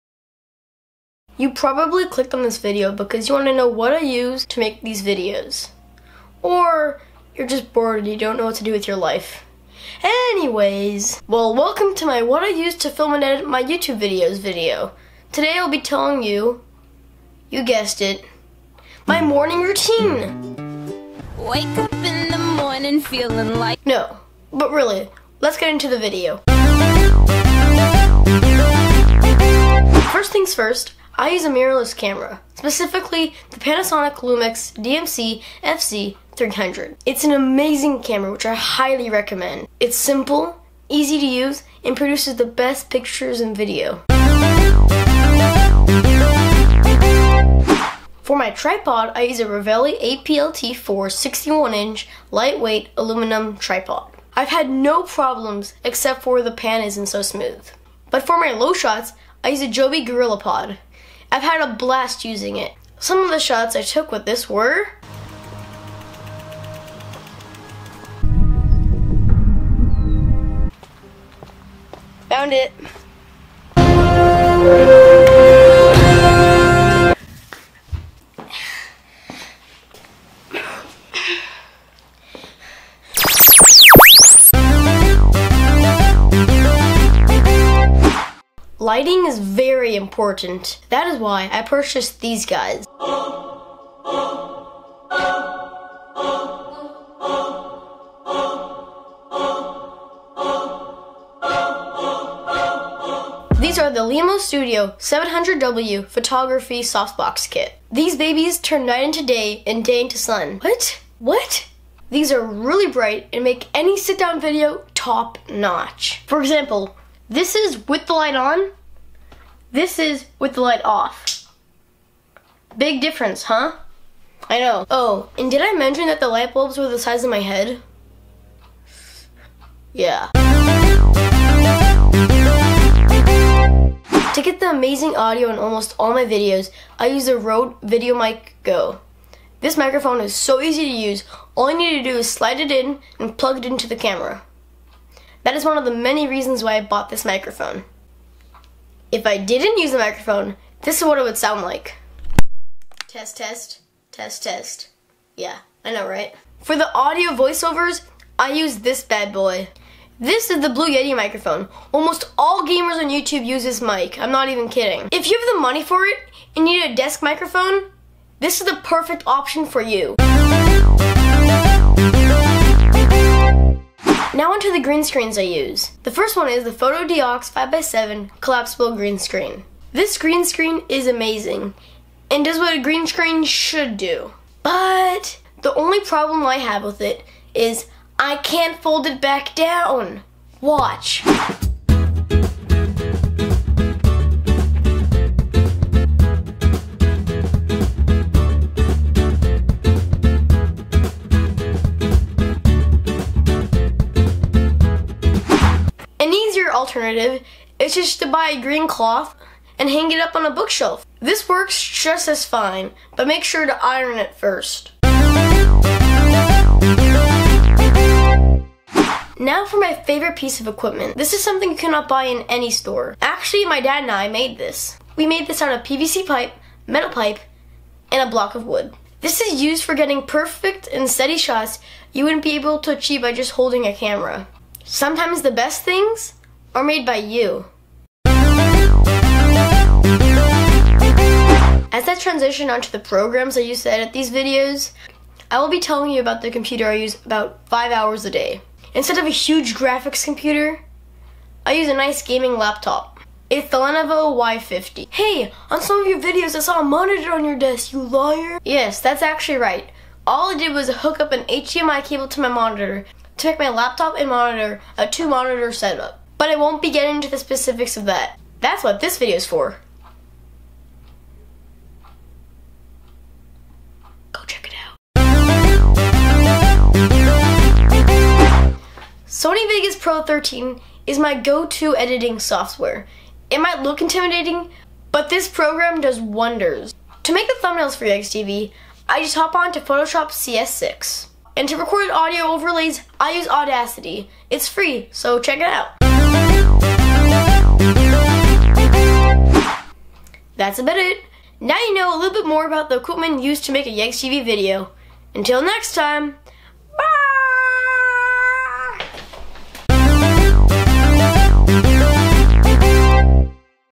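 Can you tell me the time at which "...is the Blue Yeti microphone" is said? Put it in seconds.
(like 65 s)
160 s.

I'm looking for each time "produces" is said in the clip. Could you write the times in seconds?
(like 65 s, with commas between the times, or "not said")
41 s.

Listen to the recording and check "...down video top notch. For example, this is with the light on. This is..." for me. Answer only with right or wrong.
right.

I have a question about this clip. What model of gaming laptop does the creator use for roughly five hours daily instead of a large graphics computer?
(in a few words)
Lenovo Y50.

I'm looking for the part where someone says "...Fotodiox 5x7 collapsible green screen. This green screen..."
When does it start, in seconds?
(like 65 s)
176 s.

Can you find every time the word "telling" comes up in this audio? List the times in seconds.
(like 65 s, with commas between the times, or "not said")
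15 s, 245 s.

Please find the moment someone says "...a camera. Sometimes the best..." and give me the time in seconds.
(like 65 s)
233 s.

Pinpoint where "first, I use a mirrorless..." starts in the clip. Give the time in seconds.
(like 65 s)
30 s.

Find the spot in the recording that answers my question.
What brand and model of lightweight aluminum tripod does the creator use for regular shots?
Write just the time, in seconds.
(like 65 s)
49 s.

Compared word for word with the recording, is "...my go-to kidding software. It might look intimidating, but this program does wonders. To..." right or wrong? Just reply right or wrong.
wrong.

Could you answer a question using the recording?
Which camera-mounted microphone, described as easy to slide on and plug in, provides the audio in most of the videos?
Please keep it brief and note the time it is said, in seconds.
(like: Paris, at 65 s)
Rode VideoMic Go, at 137 s.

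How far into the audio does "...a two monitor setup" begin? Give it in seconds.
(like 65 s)
264 s.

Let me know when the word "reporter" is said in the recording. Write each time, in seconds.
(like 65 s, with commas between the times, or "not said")
not said.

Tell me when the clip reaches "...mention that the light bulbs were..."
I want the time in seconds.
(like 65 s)
125 s.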